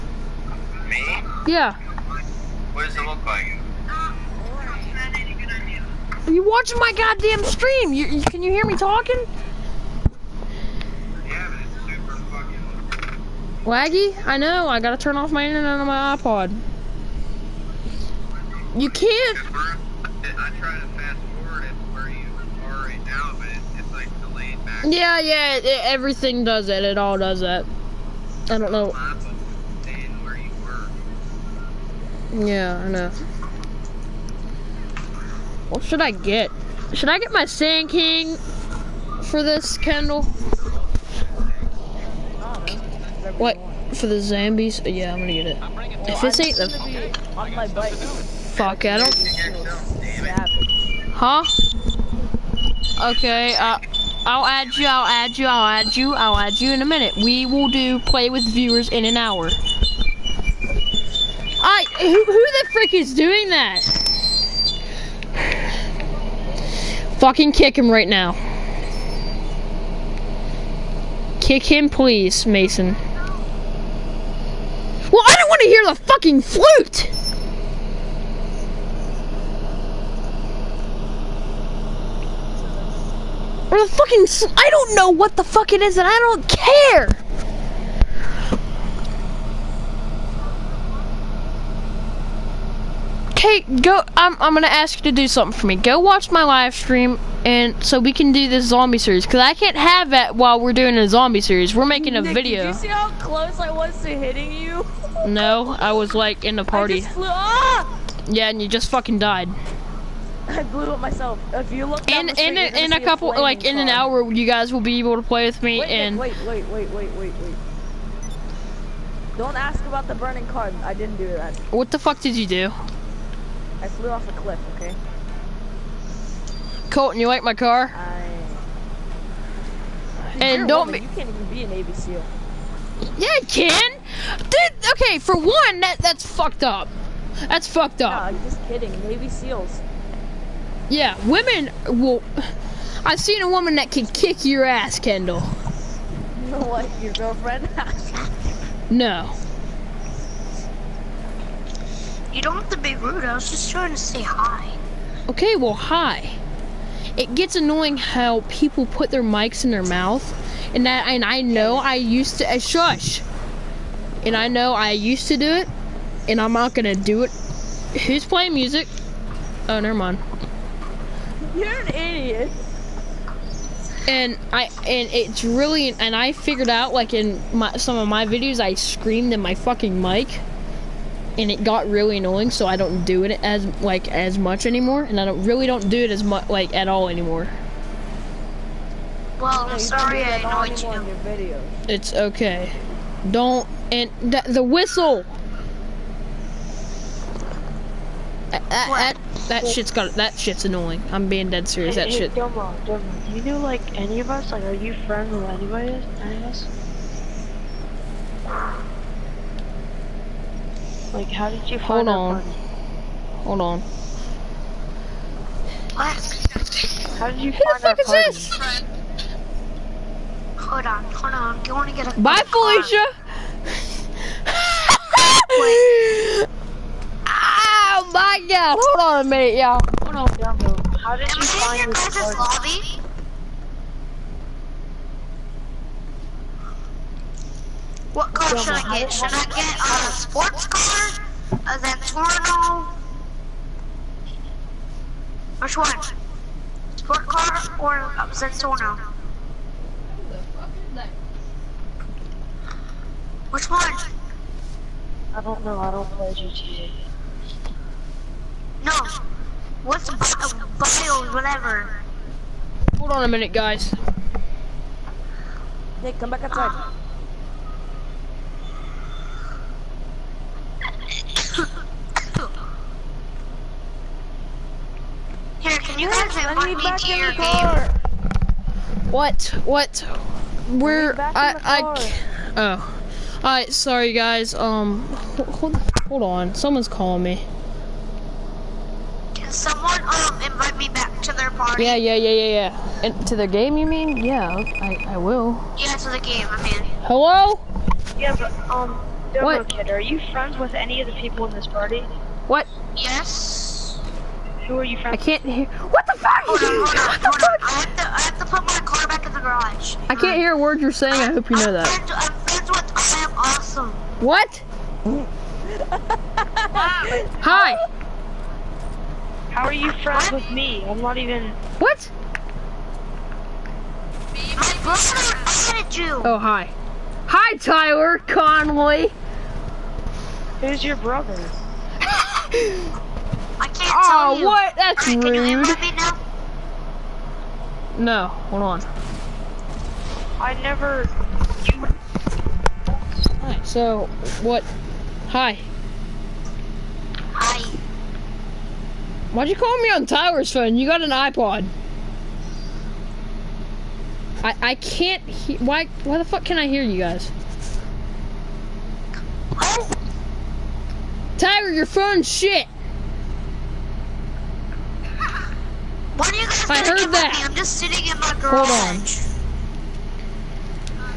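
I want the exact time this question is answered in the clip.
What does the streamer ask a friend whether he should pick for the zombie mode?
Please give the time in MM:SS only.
00:37.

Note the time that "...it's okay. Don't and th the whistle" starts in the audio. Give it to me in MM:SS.
03:11.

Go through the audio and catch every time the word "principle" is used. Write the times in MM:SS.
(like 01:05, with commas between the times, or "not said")
not said.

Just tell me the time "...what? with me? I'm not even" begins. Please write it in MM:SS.
05:20.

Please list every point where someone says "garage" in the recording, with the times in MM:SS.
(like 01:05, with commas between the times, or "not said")
05:09, 06:08.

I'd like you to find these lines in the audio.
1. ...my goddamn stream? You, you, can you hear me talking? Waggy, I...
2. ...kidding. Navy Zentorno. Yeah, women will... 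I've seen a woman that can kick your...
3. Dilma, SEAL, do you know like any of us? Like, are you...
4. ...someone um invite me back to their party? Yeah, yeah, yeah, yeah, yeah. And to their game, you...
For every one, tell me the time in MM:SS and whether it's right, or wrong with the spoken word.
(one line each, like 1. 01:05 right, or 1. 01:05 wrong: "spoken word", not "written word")
1. 00:06 right
2. 02:18 wrong: "SEALs", not "Zentorno"
3. 03:22 wrong: "Dilma", not "SEAL"
4. 04:49 right.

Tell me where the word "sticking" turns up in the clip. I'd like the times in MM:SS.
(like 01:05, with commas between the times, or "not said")
not said.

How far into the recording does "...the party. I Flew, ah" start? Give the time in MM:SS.
01:46.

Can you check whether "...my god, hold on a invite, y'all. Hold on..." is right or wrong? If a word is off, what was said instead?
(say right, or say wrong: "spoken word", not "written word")
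wrong: "minute", not "invite".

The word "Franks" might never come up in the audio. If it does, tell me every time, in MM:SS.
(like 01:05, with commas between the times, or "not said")
not said.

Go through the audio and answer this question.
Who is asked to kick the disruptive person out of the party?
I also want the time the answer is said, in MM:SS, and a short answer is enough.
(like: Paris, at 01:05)
Mason, at 01:12.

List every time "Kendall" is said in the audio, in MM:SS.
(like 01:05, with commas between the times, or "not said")
00:39, 02:24.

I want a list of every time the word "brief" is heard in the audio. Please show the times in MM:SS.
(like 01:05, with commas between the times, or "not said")
not said.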